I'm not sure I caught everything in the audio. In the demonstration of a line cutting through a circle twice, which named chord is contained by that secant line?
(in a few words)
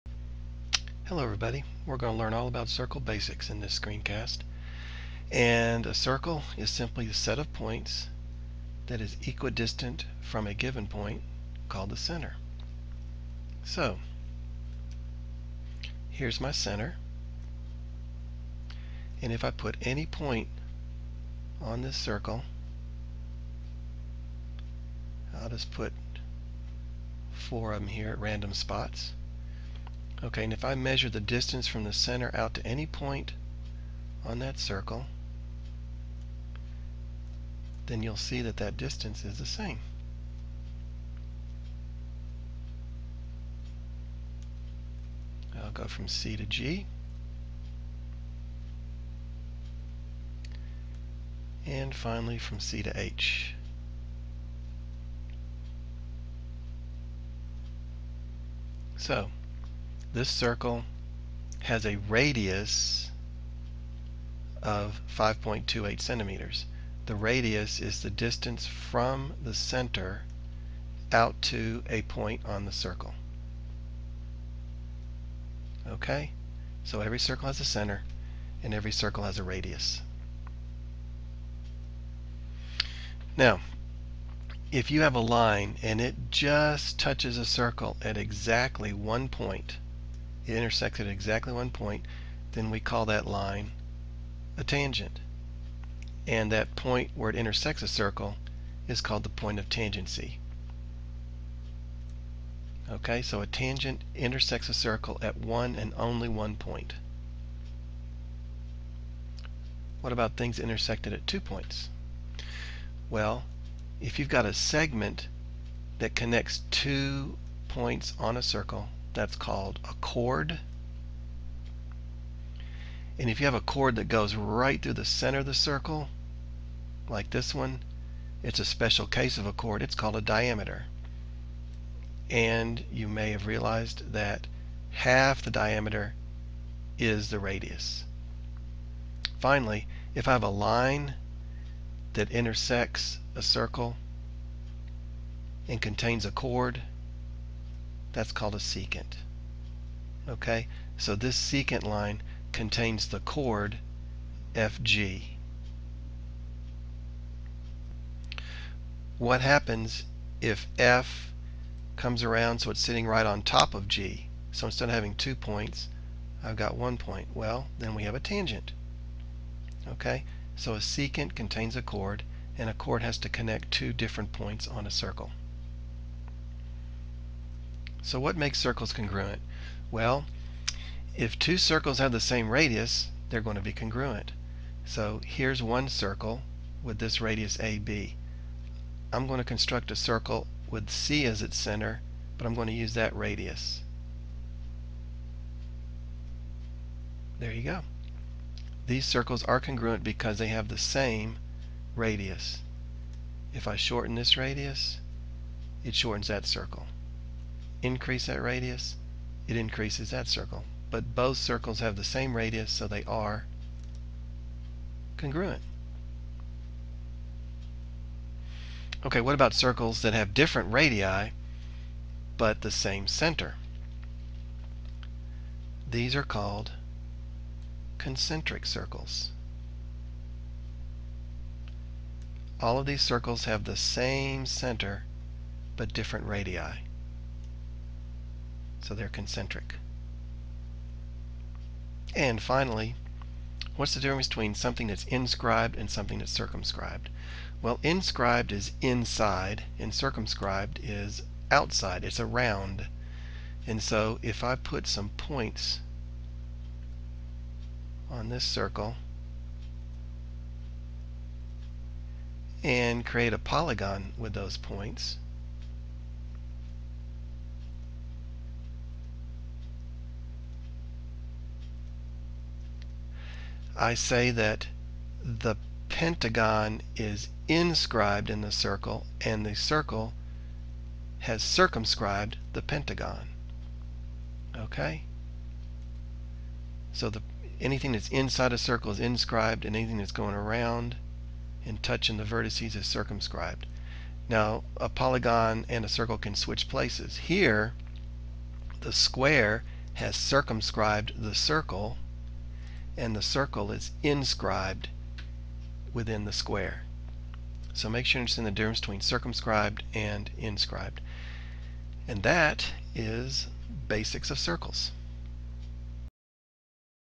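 FG.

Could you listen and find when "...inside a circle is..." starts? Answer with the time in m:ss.
4:48.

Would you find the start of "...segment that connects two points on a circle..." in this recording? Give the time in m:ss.
1:54.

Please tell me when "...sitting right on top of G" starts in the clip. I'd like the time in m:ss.
2:42.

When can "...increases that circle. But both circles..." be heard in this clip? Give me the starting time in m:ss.
3:29.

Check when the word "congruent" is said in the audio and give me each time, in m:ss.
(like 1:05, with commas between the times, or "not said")
2:58, 3:03, 3:19, 3:35.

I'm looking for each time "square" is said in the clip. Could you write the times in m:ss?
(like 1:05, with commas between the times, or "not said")
4:58, 5:06.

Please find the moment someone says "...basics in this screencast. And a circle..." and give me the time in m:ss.
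0:03.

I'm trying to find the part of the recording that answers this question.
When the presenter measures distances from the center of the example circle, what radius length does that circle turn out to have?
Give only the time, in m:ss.
1:05.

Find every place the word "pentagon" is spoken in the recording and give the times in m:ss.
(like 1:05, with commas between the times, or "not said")
4:35, 4:42.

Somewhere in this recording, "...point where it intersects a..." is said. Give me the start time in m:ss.
1:36.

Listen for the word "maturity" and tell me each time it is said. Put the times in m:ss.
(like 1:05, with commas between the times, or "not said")
not said.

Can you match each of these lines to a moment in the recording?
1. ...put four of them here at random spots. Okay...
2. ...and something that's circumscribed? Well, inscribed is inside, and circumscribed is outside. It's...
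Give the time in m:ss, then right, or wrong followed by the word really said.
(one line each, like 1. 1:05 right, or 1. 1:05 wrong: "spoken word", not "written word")
1. 0:25 right
2. 4:05 right.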